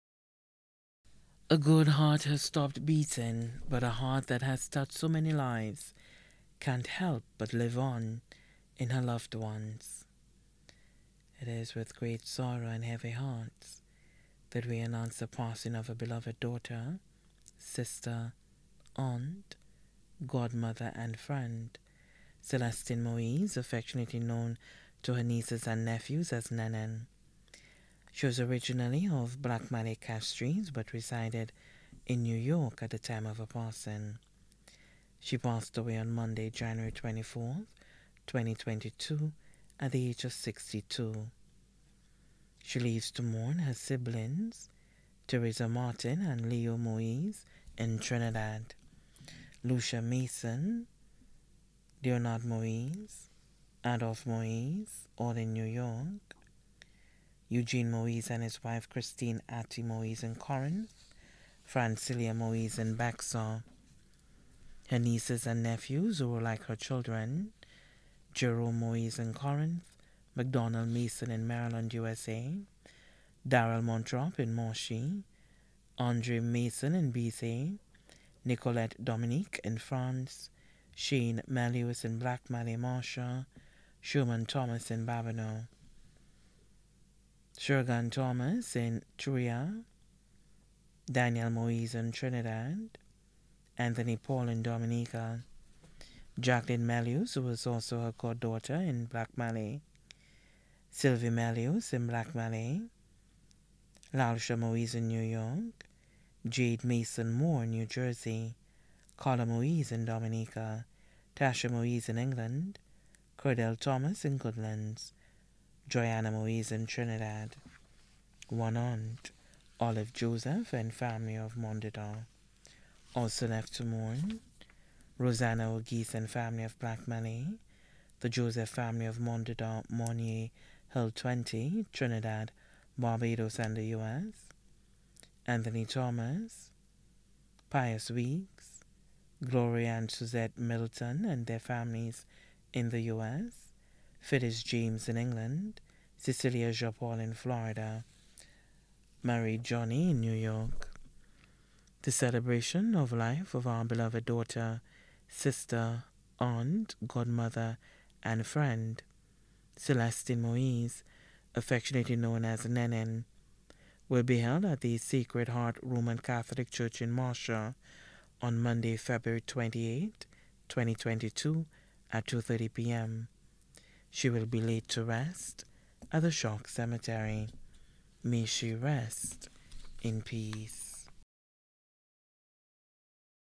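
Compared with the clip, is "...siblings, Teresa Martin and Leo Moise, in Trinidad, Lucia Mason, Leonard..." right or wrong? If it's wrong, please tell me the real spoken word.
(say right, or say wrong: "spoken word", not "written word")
right.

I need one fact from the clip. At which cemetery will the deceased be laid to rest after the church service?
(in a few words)
Choc Cemetery.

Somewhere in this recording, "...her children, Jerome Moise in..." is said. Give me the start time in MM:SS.
01:06.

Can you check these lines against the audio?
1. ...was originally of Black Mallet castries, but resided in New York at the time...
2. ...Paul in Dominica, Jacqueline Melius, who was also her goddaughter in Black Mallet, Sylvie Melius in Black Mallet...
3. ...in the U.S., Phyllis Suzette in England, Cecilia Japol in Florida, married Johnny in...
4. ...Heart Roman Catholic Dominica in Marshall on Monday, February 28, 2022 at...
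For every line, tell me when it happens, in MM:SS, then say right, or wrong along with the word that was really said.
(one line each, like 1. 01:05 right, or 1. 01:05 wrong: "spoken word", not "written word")
1. 00:28 right
2. 01:34 right
3. 02:22 wrong: "James", not "Suzette"
4. 02:45 wrong: "Church", not "Dominica".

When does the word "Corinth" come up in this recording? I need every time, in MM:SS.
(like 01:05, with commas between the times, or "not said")
01:00, 01:09.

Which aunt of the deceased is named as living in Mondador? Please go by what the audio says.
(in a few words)
Olive Joseph.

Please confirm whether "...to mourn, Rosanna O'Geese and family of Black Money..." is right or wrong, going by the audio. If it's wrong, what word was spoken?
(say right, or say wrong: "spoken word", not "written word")
right.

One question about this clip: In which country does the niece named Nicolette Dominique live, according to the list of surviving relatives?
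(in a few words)
France.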